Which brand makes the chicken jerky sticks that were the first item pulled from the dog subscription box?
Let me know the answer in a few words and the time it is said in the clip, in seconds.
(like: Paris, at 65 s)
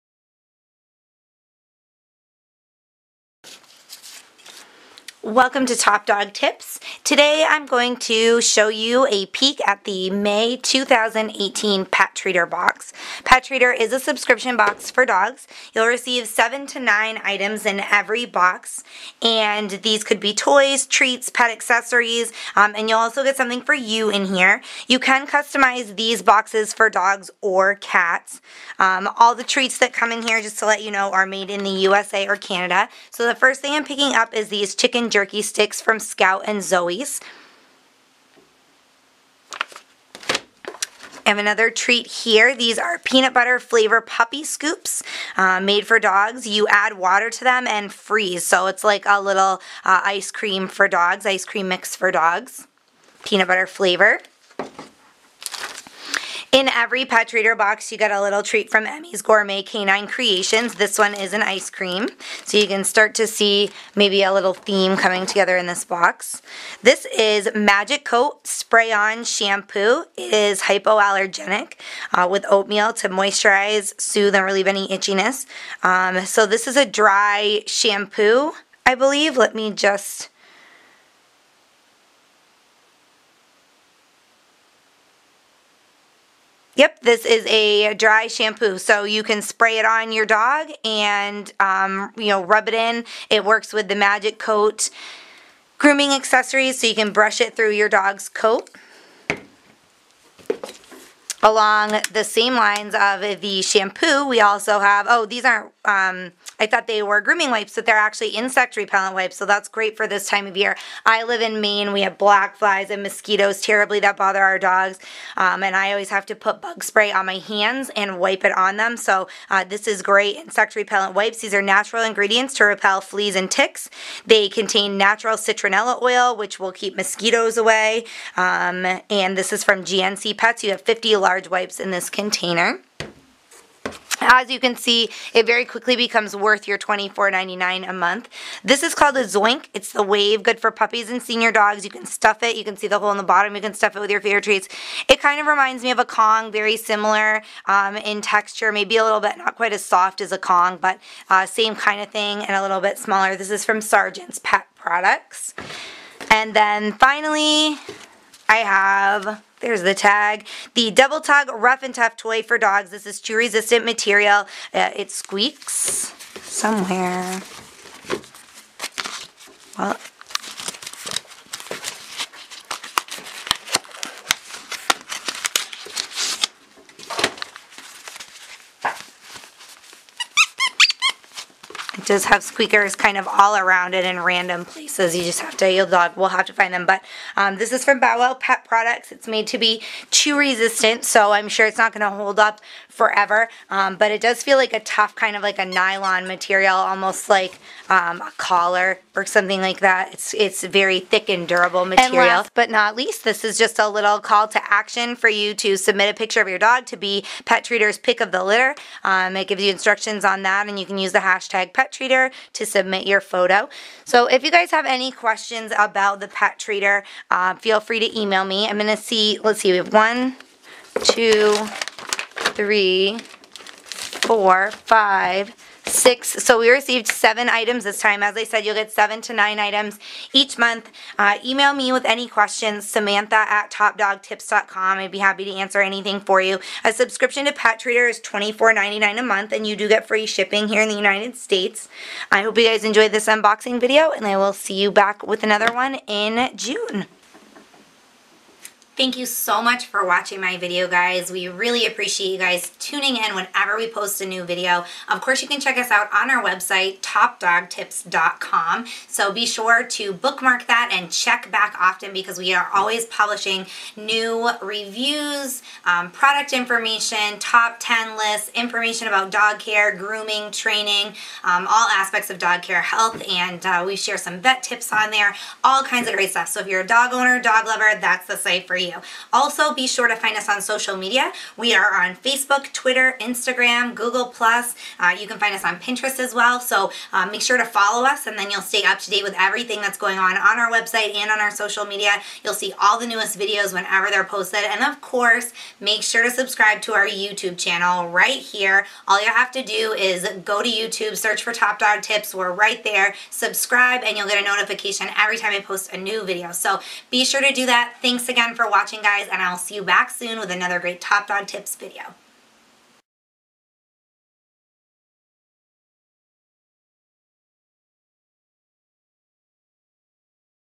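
Scout and Zoe, at 35 s.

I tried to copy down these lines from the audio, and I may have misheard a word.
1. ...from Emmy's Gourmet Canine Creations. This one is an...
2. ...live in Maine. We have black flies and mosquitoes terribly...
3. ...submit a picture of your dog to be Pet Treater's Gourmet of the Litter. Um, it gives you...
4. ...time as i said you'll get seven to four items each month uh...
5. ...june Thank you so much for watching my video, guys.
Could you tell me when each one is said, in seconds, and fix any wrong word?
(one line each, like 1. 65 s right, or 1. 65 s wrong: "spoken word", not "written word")
1. 58 s right
2. 111 s right
3. 205 s wrong: "Pick", not "Gourmet"
4. 227 s wrong: "nine", not "four"
5. 246 s right.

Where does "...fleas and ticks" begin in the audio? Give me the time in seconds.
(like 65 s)
123 s.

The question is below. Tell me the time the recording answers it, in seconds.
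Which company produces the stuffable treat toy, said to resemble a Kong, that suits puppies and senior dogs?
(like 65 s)
153 s.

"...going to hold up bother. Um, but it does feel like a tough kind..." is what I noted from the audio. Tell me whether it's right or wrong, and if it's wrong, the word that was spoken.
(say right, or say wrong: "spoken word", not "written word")
wrong: "forever", not "bother".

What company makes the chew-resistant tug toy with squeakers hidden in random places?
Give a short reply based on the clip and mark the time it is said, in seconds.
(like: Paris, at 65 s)
Bow Wow Pet Products, at 187 s.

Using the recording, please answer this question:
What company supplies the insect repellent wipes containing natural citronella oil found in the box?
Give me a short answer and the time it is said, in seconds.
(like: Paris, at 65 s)
GNC Pets, at 129 s.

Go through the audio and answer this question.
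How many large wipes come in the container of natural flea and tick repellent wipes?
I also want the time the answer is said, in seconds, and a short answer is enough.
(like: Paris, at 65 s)
50, at 130 s.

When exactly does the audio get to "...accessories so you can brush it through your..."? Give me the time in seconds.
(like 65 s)
96 s.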